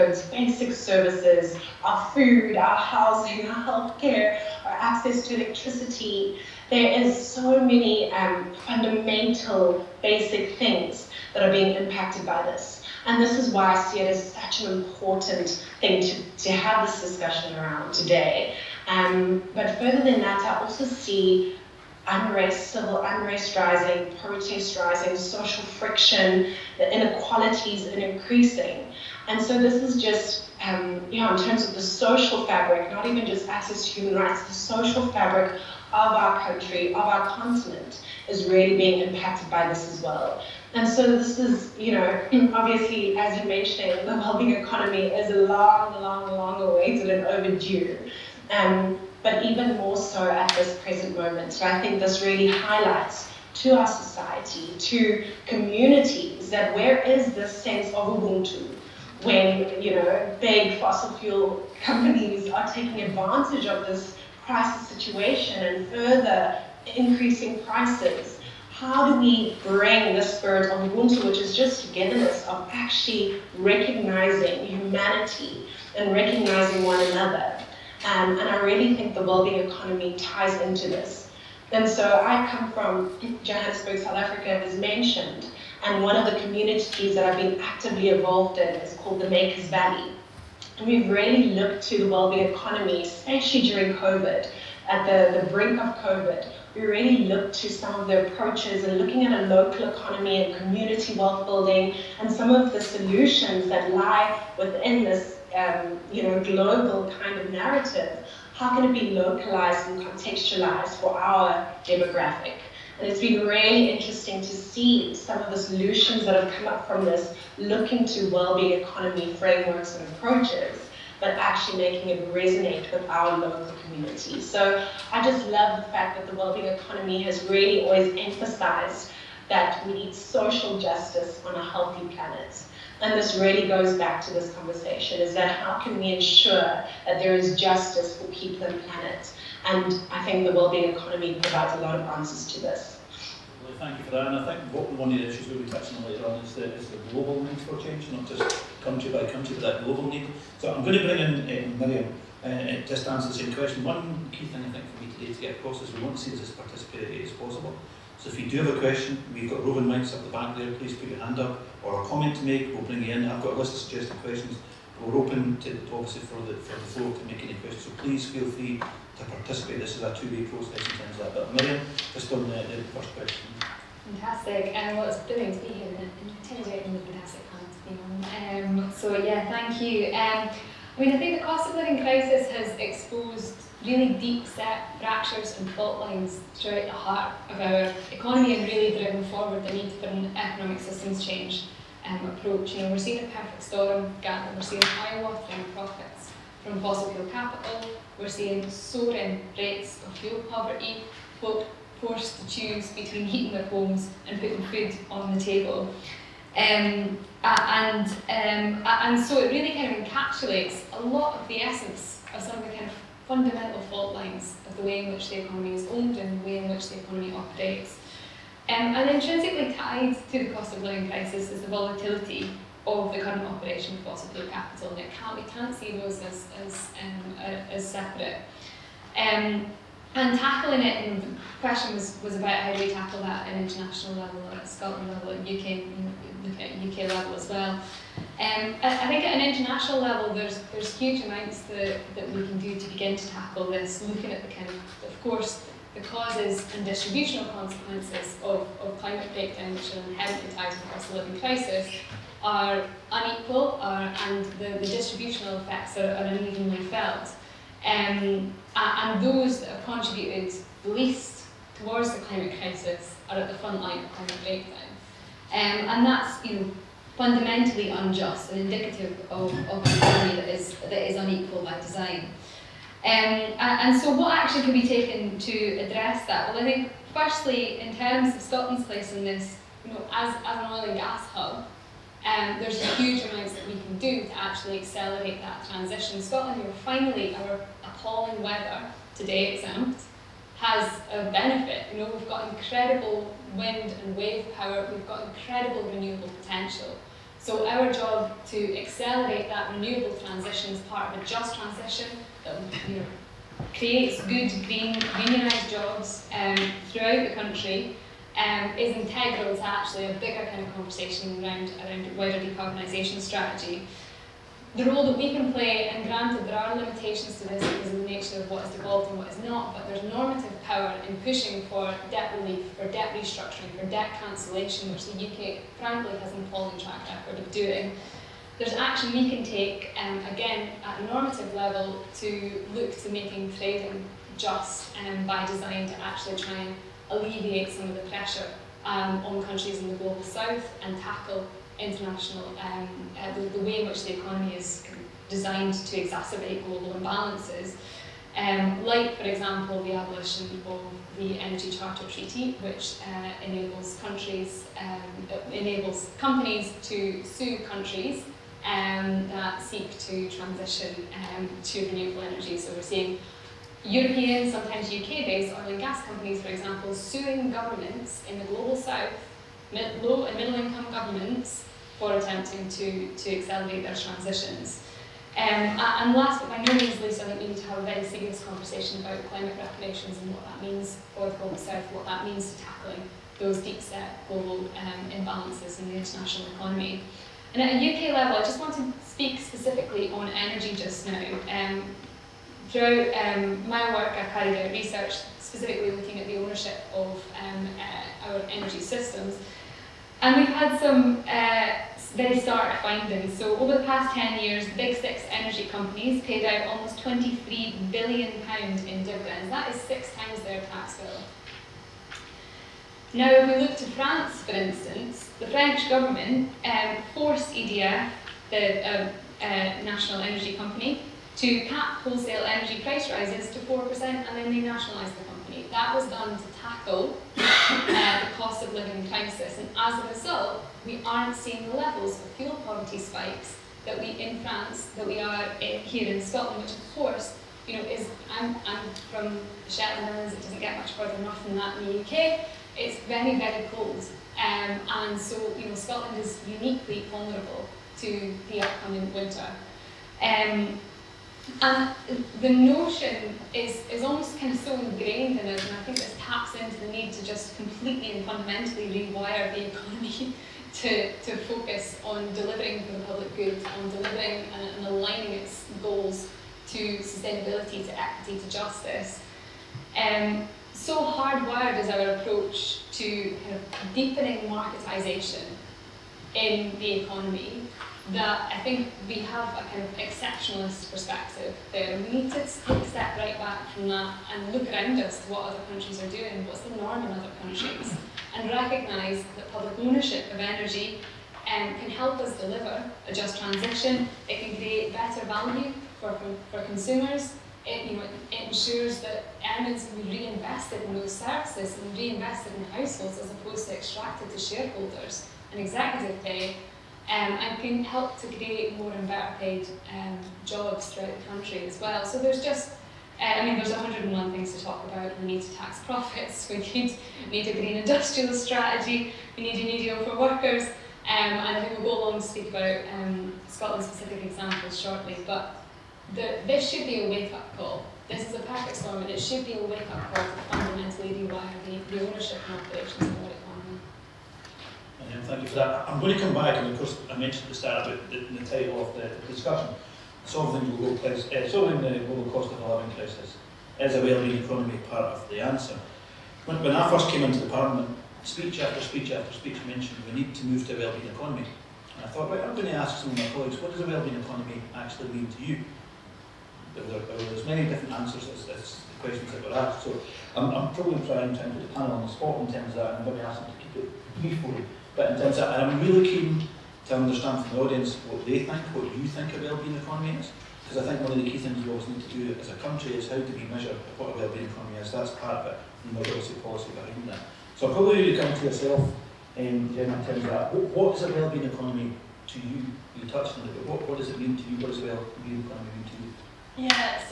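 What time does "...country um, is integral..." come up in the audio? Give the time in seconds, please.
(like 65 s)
307 s.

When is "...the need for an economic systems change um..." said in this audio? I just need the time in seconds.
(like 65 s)
189 s.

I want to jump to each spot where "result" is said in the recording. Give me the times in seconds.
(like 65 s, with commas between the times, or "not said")
430 s.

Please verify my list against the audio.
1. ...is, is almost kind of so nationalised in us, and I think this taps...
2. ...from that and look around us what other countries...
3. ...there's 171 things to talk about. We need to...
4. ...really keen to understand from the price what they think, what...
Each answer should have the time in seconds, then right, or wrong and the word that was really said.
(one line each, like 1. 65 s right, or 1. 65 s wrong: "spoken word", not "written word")
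1. 453 s wrong: "ingrained", not "nationalised"
2. 483 s right
3. 513 s wrong: "101", not "171"
4. 565 s wrong: "audience", not "price".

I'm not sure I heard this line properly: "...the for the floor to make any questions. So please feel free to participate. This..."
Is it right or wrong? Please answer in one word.
right.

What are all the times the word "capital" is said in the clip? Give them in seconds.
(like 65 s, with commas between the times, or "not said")
197 s, 224 s.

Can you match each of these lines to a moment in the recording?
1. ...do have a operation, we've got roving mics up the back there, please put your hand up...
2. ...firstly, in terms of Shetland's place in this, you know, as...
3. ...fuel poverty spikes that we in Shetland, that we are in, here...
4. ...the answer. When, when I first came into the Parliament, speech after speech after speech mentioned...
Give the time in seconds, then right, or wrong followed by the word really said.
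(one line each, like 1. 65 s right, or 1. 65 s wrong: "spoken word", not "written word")
1. 158 s wrong: "question", not "operation"
2. 277 s wrong: "Scotland", not "Shetland"
3. 432 s wrong: "France", not "Shetland"
4. 545 s right.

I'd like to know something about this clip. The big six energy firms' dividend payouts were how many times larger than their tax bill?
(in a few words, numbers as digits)
6.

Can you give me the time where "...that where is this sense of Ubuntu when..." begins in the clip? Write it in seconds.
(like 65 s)
56 s.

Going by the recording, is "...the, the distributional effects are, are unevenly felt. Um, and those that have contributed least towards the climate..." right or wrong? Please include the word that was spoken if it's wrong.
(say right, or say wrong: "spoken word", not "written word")
right.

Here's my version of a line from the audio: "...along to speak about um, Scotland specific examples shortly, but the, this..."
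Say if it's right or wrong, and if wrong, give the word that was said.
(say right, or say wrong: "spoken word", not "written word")
right.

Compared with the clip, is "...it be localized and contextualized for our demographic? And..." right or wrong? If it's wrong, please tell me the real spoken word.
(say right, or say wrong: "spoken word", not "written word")
right.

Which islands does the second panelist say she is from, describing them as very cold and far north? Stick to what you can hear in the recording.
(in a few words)
Shetland Islands.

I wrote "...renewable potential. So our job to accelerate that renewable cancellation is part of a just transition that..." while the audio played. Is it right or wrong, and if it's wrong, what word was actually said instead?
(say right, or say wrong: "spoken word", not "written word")
wrong: "transition", not "cancellation".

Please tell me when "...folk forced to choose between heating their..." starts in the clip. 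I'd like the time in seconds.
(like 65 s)
201 s.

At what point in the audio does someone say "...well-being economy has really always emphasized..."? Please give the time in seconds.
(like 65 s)
126 s.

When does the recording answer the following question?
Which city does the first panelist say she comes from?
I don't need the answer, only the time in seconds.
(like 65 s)
83 s.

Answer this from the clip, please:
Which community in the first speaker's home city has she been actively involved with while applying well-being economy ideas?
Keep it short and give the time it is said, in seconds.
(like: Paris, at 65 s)
Makers Valley, at 89 s.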